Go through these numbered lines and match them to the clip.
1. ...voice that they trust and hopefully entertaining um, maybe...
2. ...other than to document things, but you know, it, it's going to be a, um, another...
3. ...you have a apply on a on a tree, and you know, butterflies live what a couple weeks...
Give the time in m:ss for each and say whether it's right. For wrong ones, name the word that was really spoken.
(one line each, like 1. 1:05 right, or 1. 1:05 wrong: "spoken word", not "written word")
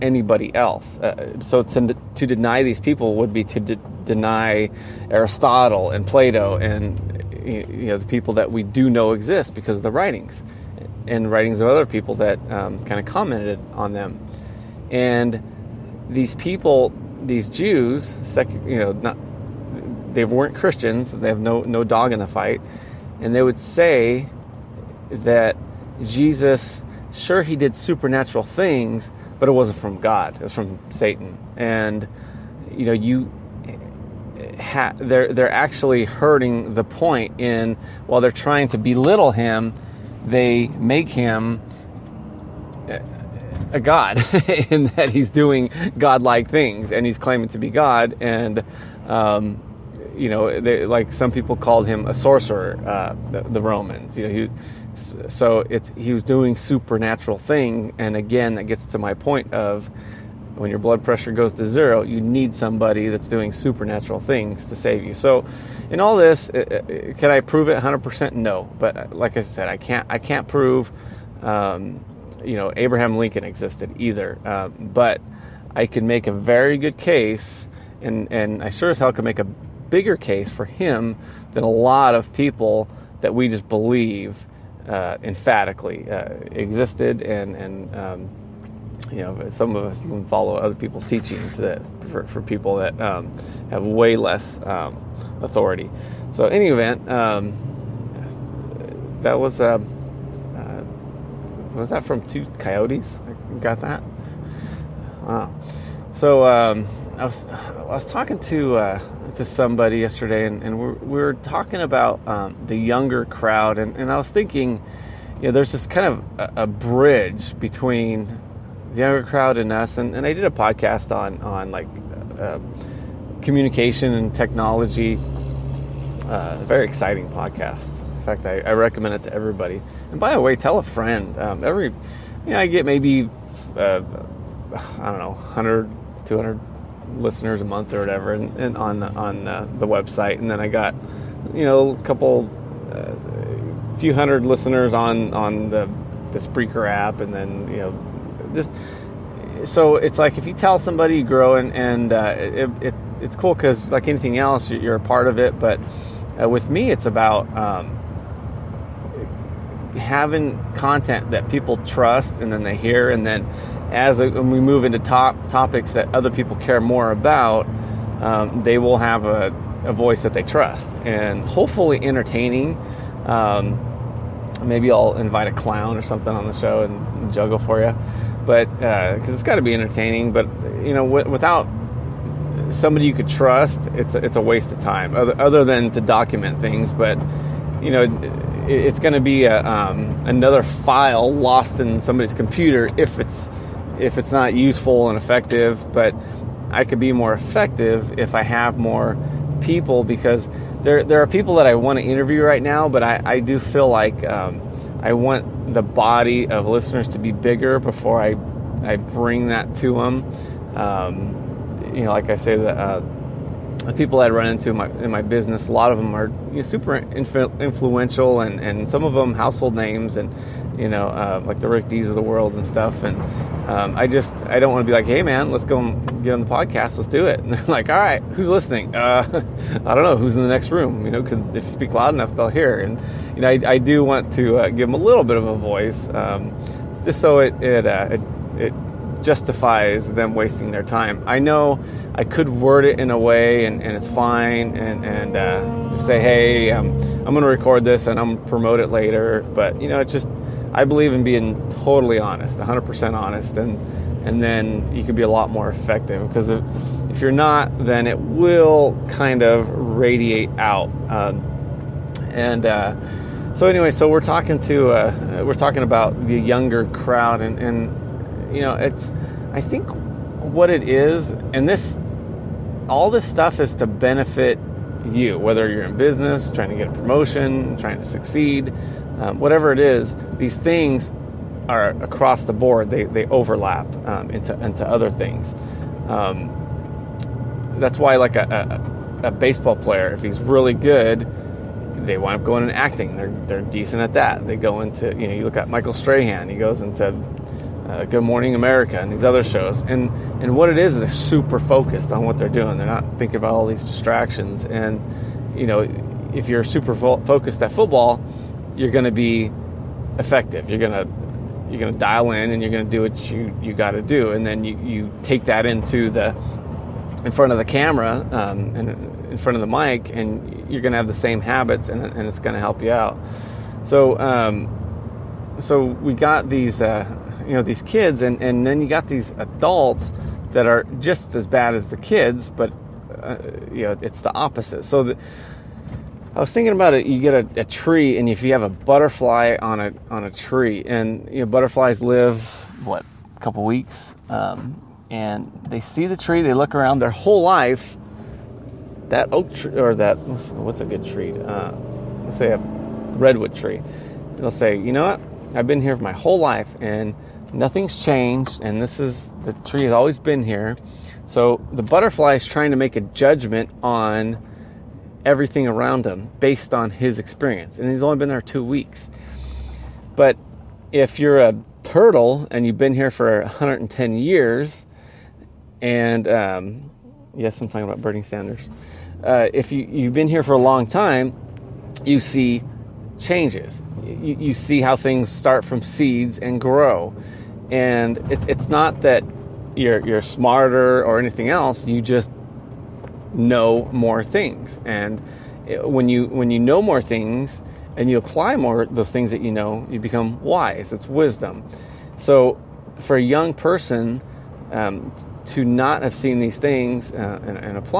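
1. 2:49 right
2. 3:05 right
3. 5:38 wrong: "butterfly", not "apply".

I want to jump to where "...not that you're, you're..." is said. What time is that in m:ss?
6:28.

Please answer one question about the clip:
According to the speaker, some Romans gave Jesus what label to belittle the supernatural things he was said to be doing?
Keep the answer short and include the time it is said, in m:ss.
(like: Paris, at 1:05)
sorcerer, at 0:52.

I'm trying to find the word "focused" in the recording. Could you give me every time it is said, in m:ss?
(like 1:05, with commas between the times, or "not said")
5:01, 5:07.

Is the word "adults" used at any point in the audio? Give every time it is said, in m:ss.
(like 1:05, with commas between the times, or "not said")
5:29.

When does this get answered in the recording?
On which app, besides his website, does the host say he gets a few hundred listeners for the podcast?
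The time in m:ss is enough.
2:26.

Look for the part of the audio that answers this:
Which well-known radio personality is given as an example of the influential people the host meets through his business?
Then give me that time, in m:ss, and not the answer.
3:41.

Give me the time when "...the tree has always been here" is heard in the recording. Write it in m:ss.
5:59.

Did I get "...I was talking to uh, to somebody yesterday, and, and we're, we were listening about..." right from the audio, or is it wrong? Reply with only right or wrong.
wrong.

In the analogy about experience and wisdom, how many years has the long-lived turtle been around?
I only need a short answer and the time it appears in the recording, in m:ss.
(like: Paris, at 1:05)
110, at 6:13.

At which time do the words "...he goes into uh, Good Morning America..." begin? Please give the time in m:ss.
4:56.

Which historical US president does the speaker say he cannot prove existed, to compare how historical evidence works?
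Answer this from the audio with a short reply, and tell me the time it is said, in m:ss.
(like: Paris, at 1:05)
Abraham Lincoln, at 1:12.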